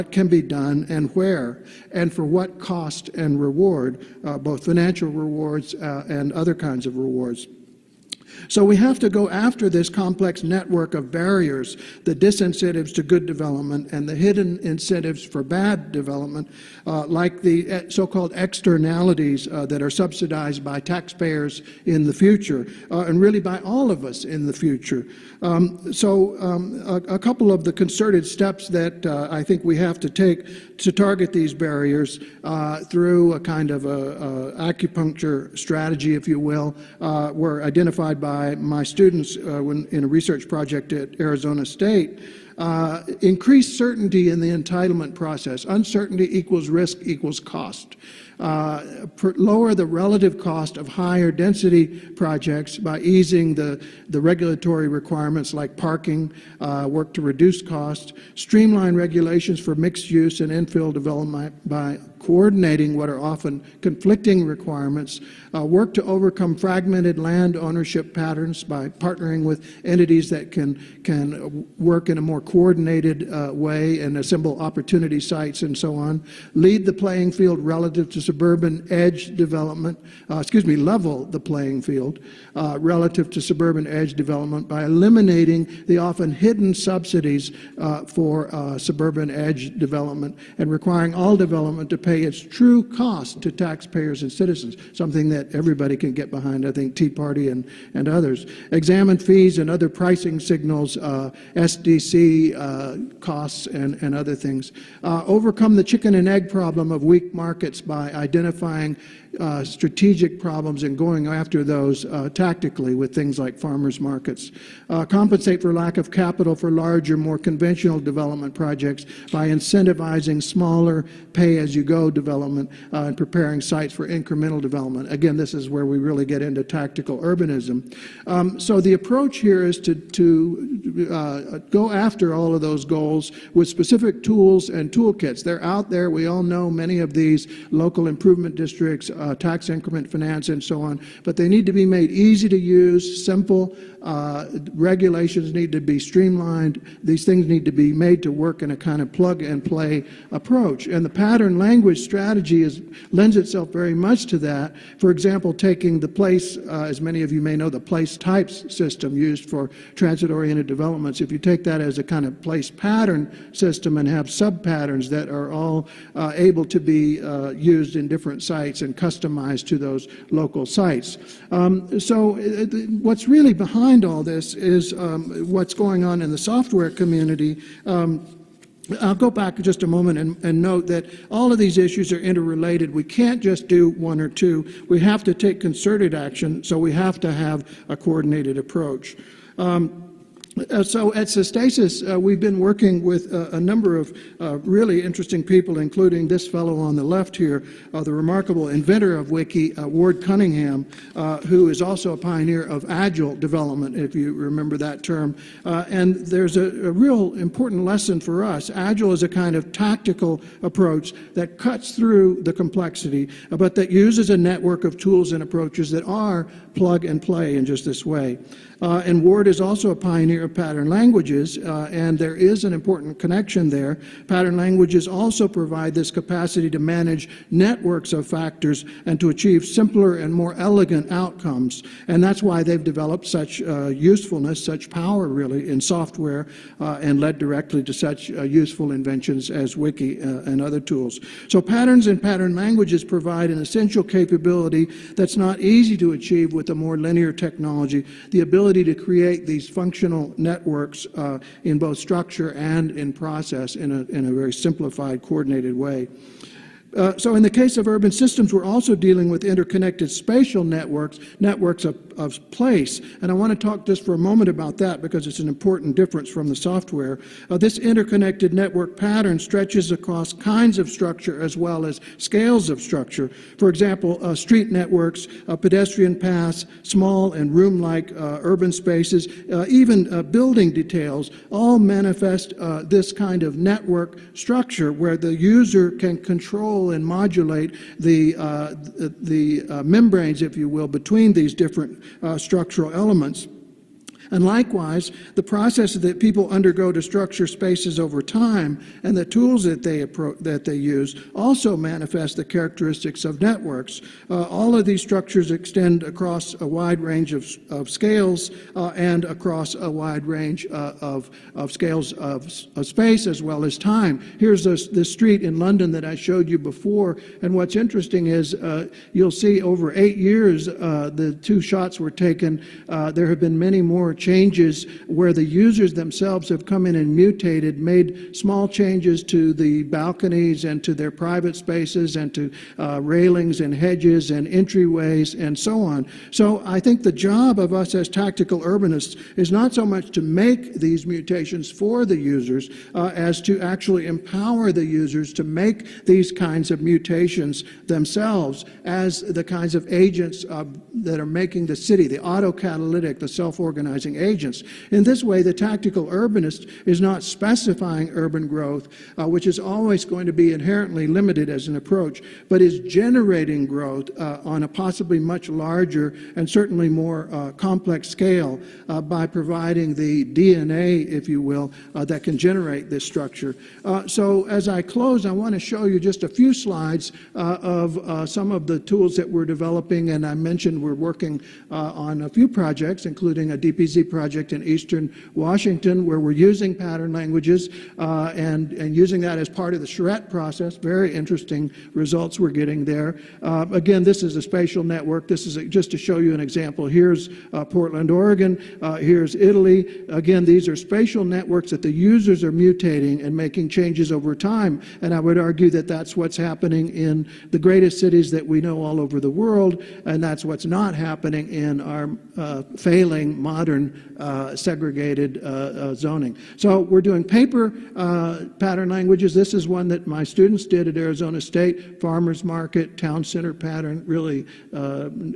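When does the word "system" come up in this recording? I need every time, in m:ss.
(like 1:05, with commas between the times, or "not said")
2:38, 2:43, 4:18.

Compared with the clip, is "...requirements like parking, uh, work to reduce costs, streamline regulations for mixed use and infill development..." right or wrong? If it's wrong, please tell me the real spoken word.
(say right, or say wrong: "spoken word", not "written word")
right.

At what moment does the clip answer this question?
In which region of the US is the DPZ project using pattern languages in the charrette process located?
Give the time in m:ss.
6:24.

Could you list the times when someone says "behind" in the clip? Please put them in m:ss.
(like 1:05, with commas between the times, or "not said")
1:36, 2:53.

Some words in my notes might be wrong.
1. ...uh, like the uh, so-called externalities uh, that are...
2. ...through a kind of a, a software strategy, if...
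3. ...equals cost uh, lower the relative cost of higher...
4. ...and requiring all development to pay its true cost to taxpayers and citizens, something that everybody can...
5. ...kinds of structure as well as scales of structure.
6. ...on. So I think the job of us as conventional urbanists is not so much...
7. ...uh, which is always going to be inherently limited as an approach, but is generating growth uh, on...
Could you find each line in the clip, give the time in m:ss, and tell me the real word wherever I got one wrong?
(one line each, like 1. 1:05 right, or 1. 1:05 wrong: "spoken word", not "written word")
1. 0:16 right
2. 0:32 wrong: "acupuncture", not "software"
3. 0:47 right
4. 1:30 right
5. 4:30 right
6. 5:35 wrong: "tactical", not "conventional"
7. 5:59 right.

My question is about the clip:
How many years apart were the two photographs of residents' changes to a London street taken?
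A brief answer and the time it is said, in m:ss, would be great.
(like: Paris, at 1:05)
8, at 5:19.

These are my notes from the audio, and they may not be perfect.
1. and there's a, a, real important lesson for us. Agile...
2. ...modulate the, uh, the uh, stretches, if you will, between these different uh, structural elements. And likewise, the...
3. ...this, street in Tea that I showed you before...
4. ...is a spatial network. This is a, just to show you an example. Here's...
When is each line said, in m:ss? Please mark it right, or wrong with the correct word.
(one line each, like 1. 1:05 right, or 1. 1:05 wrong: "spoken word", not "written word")
1. 3:25 right
2. 4:47 wrong: "membranes", not "stretches"
3. 5:14 wrong: "London", not "Tea"
4. 6:34 right.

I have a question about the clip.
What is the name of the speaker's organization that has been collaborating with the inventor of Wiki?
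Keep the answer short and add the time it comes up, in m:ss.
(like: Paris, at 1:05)
Sustasis, at 3:11.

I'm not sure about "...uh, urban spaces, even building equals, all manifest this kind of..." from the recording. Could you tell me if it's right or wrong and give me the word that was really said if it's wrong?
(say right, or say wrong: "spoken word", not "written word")
wrong: "details", not "equals".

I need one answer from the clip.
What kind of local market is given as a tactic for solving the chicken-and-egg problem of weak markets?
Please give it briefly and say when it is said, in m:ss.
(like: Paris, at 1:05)
Farmers markets, at 1:53.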